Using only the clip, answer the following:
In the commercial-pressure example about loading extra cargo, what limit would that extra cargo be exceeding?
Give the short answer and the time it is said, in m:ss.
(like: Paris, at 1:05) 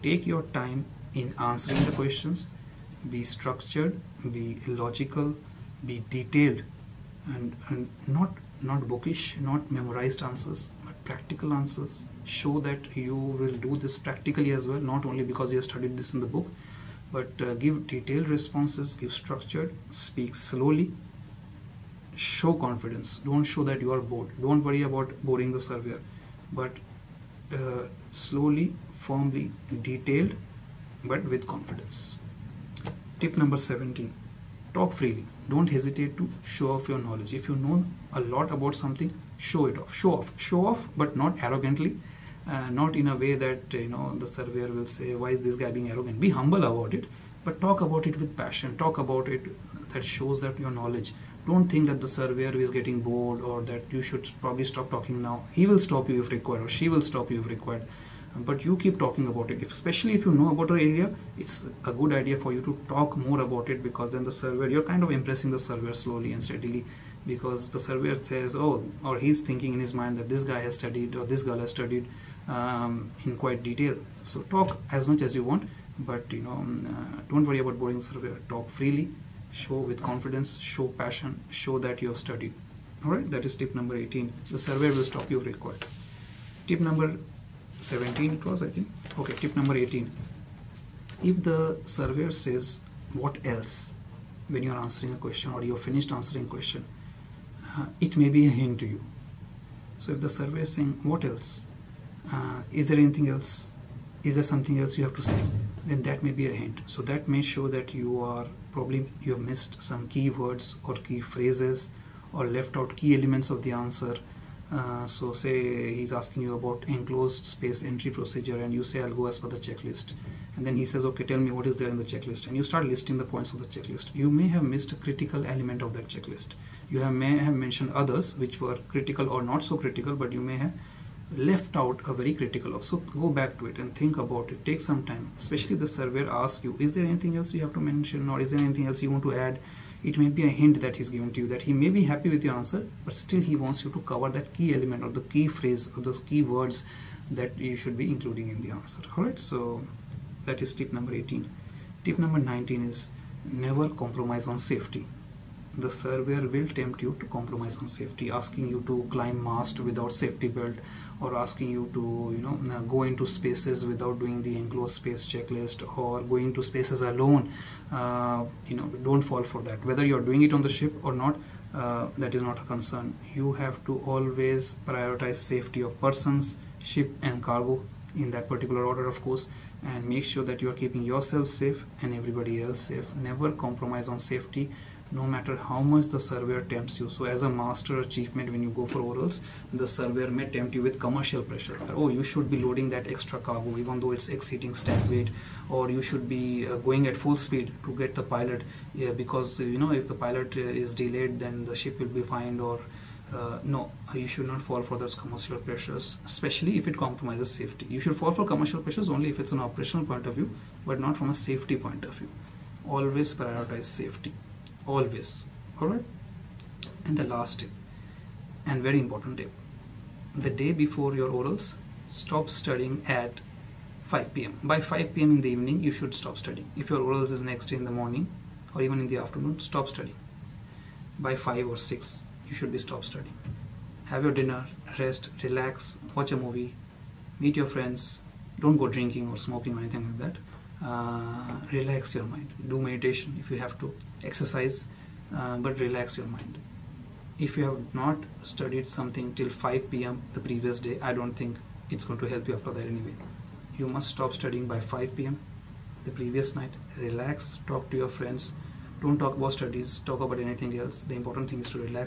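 stack weight, at 3:14.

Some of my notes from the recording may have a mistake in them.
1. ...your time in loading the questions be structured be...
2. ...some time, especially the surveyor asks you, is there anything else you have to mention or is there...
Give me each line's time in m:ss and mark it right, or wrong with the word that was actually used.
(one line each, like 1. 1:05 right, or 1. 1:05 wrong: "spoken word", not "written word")
1. 0:00 wrong: "answering", not "loading"
2. 2:14 right.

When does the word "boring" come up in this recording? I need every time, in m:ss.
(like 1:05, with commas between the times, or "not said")
0:25, 1:17.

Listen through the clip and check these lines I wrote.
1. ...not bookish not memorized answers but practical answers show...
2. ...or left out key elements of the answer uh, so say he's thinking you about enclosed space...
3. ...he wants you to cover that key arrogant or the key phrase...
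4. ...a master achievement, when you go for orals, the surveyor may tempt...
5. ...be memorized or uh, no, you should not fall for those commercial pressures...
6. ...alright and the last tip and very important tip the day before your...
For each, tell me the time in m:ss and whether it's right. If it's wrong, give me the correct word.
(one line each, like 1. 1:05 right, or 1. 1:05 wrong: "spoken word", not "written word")
1. 0:08 right
2. 1:52 wrong: "asking", not "thinking"
3. 2:23 wrong: "element", not "arrogant"
4. 3:07 right
5. 3:22 wrong: "fined", not "memorized"
6. 3:35 right.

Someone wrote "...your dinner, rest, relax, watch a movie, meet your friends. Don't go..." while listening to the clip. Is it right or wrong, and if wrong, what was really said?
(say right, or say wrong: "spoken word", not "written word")
right.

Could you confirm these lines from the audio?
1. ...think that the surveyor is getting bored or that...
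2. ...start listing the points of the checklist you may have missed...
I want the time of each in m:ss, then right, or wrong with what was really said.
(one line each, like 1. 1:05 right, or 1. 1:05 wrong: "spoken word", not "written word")
1. 0:51 right
2. 2:02 right.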